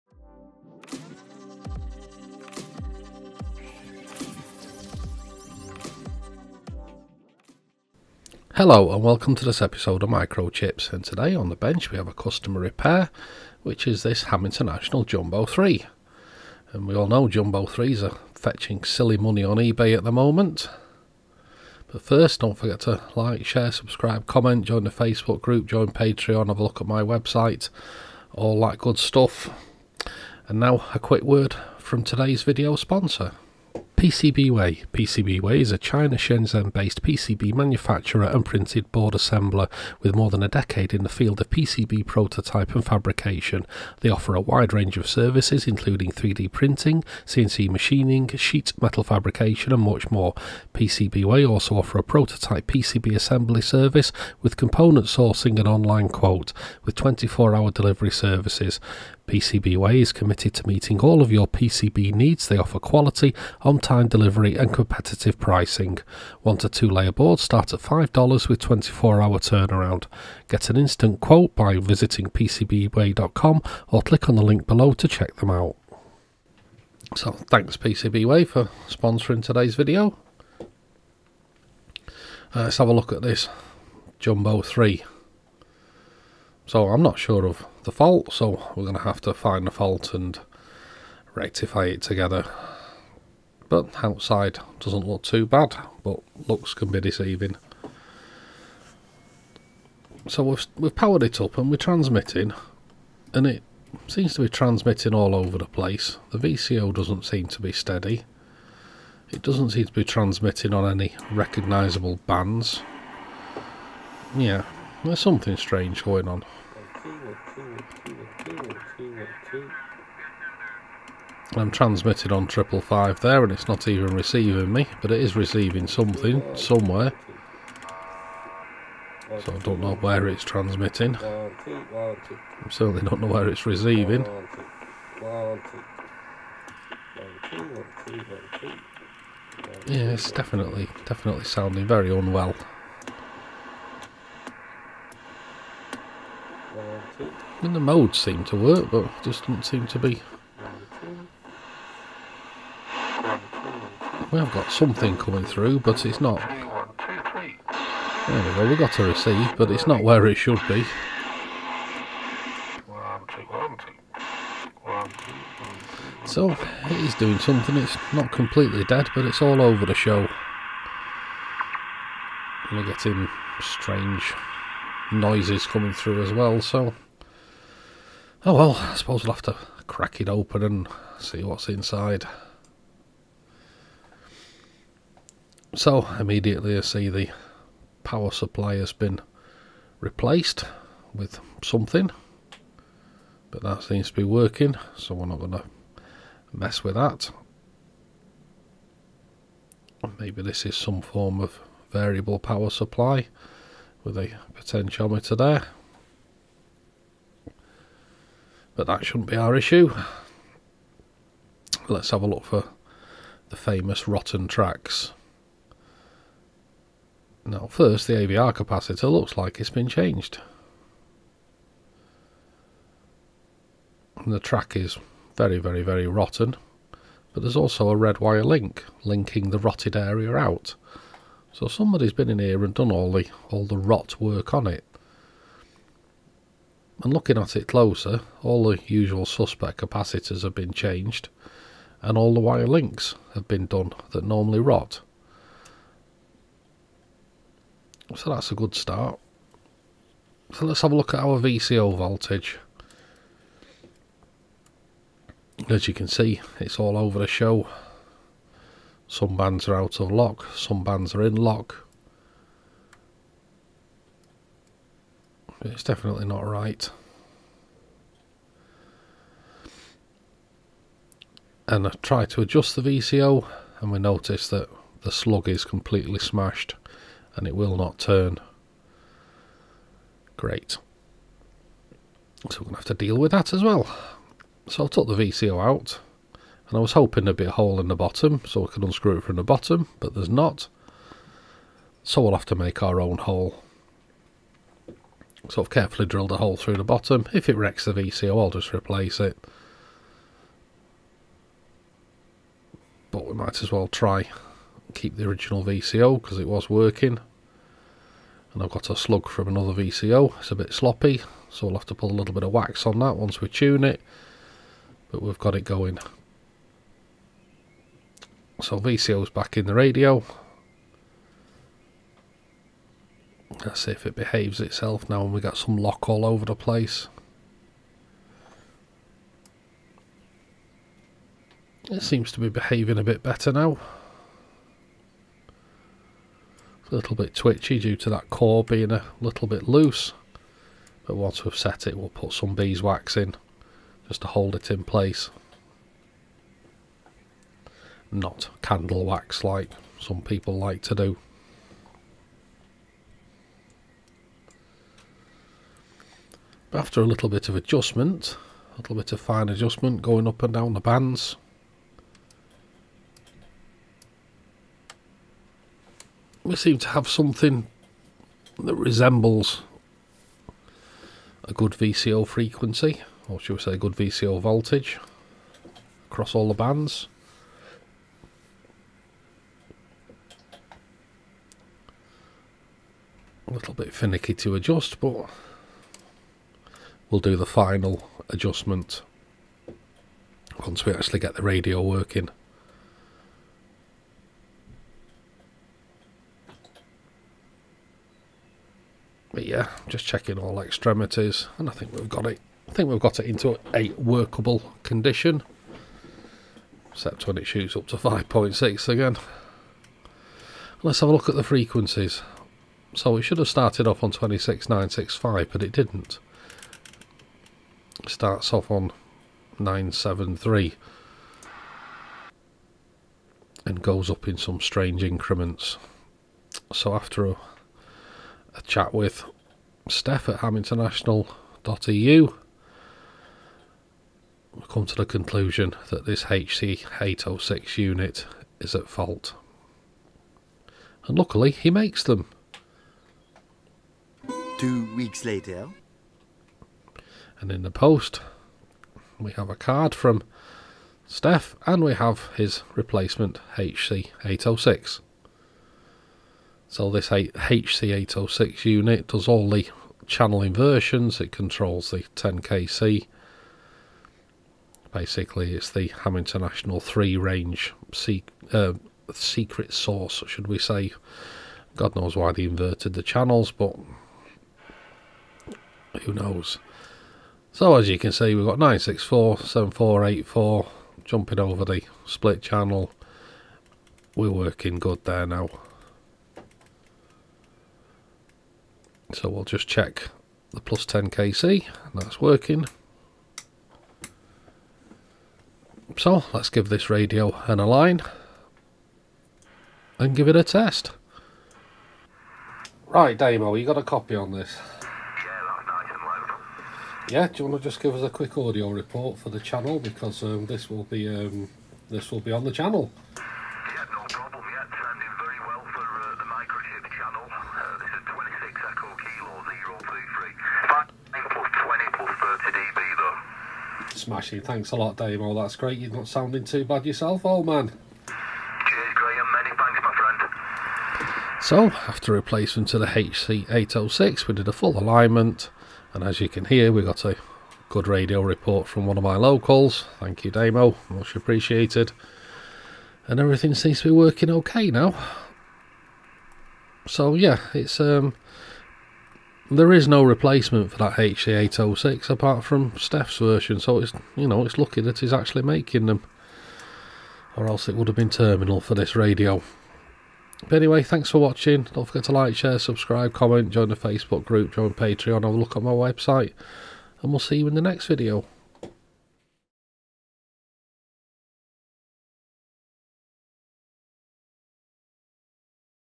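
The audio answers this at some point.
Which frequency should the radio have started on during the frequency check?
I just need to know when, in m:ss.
6:54.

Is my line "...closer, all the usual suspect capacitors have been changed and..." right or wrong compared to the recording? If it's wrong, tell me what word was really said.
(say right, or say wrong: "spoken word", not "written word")
right.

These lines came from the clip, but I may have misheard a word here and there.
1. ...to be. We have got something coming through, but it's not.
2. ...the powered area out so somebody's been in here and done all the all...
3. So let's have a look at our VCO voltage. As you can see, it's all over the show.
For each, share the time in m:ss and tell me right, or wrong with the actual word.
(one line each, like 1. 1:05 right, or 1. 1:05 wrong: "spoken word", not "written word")
1. 2:29 right
2. 3:49 wrong: "rotted", not "powered"
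3. 4:10 right.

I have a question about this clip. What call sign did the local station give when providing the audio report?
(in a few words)
26 Echo Kilo 033.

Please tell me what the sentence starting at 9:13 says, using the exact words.
So it's you know it's lucky that he's actually making them, or else it would have been terminal for this radio.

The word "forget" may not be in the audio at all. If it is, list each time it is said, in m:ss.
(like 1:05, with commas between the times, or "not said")
0:22, 9:21.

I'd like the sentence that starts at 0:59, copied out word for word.
PCBWay is committed to meeting all of your PCB needs.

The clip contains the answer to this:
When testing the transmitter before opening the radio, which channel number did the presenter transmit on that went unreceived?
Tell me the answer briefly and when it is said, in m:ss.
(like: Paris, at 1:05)
555, at 2:02.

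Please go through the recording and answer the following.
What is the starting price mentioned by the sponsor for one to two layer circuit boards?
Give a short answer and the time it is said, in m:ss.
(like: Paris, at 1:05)
$5, at 1:07.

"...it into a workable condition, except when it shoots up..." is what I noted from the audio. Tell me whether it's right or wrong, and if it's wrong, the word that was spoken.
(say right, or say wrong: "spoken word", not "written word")
right.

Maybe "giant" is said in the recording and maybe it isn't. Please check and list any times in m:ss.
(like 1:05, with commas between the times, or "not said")
not said.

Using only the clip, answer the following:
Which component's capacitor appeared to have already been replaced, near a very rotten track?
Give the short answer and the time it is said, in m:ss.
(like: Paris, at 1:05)
AVR capacitor, at 3:38.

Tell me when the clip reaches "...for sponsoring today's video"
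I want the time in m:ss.
1:18.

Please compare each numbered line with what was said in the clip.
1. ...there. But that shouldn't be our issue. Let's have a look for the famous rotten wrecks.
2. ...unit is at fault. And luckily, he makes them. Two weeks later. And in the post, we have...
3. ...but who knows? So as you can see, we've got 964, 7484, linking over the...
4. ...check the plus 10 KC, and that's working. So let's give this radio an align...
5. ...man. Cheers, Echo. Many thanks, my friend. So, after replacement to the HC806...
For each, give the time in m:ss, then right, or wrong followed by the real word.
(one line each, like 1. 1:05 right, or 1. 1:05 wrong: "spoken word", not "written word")
1. 3:25 wrong: "tracks", not "wrecks"
2. 7:17 right
3. 7:53 wrong: "jumping", not "linking"
4. 8:09 right
5. 8:47 wrong: "Graham", not "Echo".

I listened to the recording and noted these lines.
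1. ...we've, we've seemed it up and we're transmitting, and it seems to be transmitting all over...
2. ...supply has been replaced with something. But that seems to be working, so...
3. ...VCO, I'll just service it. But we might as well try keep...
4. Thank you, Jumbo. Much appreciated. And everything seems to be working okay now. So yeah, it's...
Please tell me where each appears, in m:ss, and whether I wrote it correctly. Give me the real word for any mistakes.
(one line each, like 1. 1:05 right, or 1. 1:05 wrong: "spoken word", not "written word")
1. 1:40 wrong: "powered", not "seemed"
2. 3:08 right
3. 4:57 wrong: "replace", not "service"
4. 8:59 wrong: "Damo", not "Jumbo".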